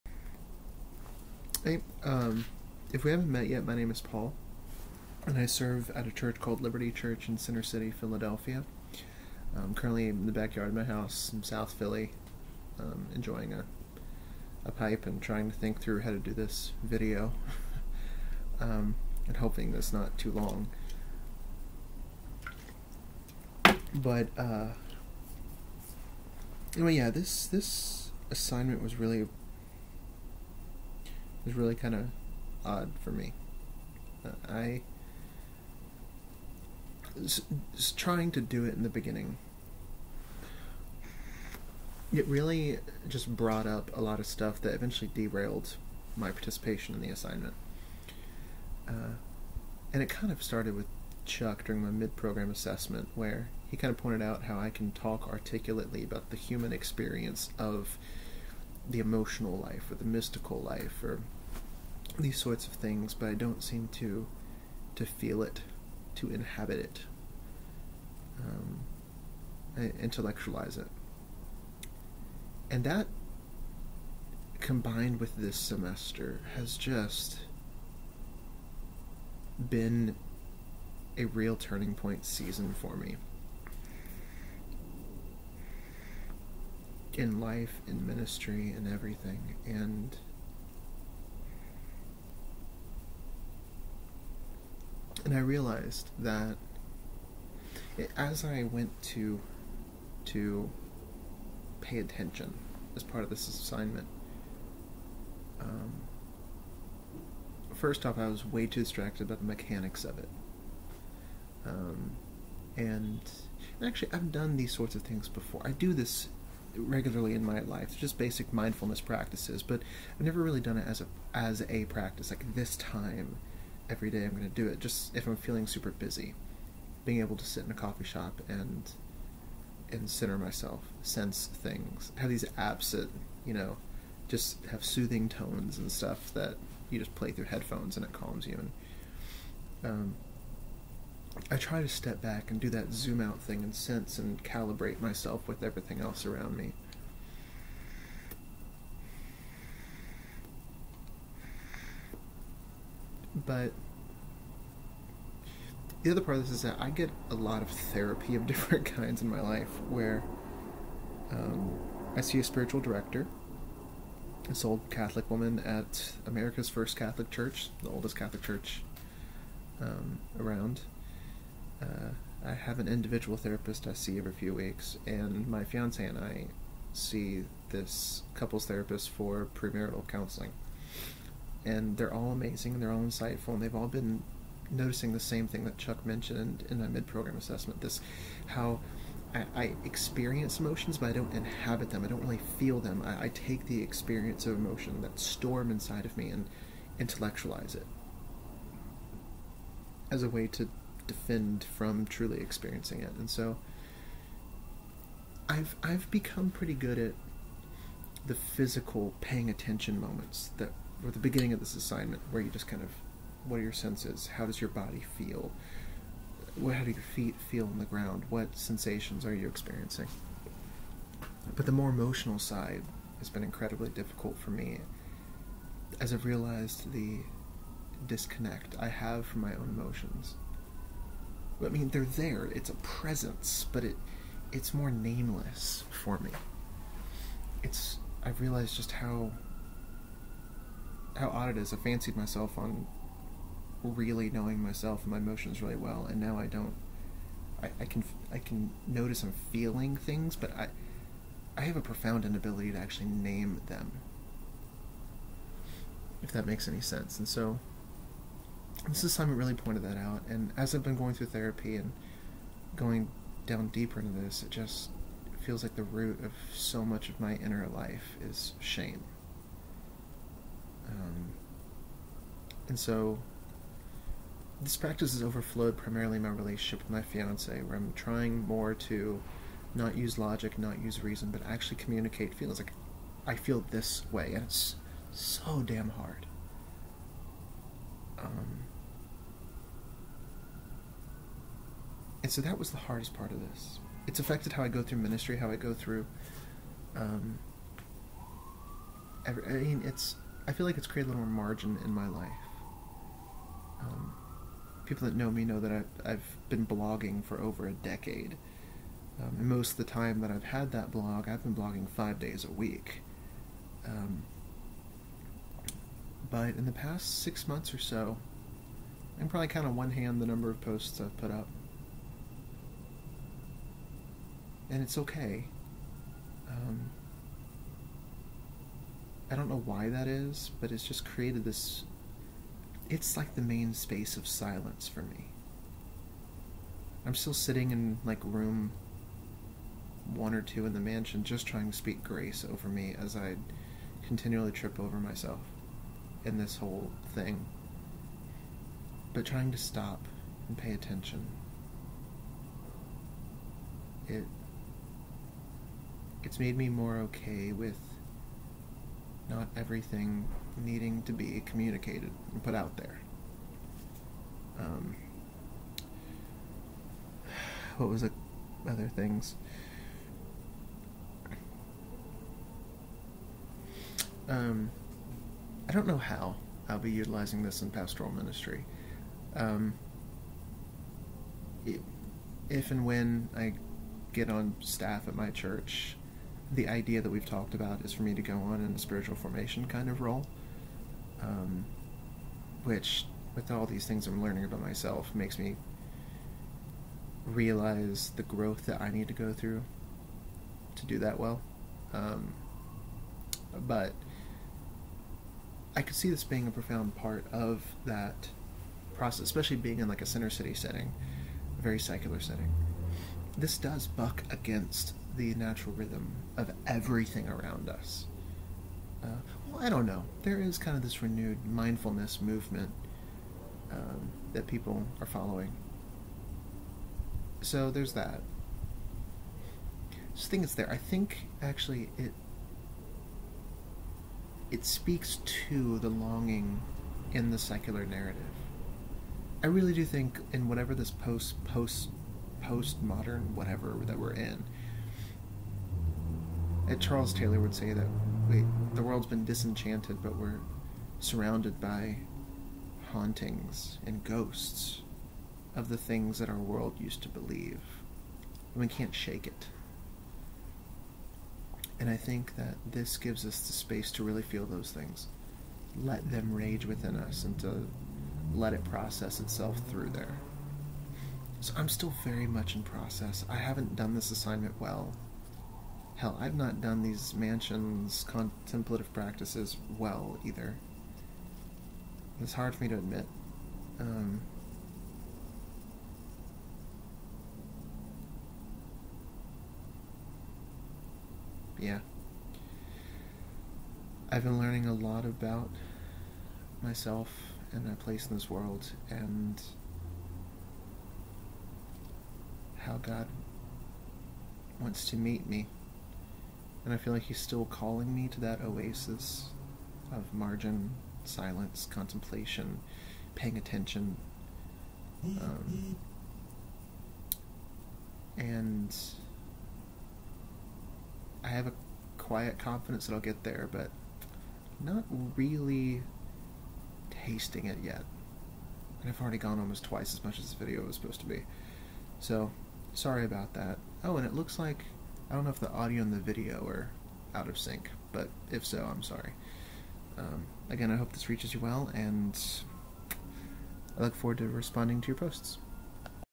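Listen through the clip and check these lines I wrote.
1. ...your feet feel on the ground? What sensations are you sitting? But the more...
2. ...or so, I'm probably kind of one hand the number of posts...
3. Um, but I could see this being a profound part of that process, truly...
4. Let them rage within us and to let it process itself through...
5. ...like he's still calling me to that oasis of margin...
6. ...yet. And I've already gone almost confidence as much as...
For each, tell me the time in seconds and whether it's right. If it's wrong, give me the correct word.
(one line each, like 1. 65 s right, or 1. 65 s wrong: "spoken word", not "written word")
1. 216 s wrong: "experiencing", not "sitting"
2. 317 s right
3. 401 s wrong: "especially", not "truly"
4. 465 s right
5. 506 s right
6. 527 s wrong: "twice", not "confidence".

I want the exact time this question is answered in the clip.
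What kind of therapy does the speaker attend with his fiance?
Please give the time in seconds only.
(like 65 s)
179 s.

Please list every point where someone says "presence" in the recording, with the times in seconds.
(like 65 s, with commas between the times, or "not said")
232 s.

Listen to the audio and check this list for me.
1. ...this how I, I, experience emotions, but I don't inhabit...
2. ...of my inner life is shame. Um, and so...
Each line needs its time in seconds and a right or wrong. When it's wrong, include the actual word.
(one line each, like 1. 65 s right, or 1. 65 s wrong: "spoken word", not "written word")
1. 187 s right
2. 267 s right.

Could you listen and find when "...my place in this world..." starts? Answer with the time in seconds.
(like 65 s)
497 s.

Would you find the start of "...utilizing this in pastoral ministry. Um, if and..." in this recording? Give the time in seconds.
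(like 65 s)
376 s.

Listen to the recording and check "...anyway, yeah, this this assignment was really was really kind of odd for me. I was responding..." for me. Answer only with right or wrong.
wrong.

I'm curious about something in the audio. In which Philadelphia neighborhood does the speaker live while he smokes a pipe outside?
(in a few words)
South Philly.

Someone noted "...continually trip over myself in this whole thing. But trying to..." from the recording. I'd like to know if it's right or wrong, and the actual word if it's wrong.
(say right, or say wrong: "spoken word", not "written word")
right.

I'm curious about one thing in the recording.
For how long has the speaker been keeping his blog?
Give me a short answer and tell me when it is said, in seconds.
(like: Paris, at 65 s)
Over a decade, at 307 s.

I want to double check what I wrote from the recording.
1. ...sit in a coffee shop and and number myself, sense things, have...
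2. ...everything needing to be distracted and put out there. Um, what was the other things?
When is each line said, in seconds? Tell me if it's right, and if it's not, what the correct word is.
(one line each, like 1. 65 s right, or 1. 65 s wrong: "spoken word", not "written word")
1. 127 s wrong: "center", not "number"
2. 359 s wrong: "communicated", not "distracted".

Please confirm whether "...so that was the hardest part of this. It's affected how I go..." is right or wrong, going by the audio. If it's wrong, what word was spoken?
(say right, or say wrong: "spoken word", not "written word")
right.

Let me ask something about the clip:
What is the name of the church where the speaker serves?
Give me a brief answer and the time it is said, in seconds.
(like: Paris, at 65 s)
Liberty Church, at 6 s.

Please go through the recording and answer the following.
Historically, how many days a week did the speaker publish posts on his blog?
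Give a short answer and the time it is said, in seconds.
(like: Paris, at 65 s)
5, at 311 s.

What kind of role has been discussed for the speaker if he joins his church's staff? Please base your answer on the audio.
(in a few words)
Spiritual formation.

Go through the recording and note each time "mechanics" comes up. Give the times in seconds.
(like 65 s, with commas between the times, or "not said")
109 s.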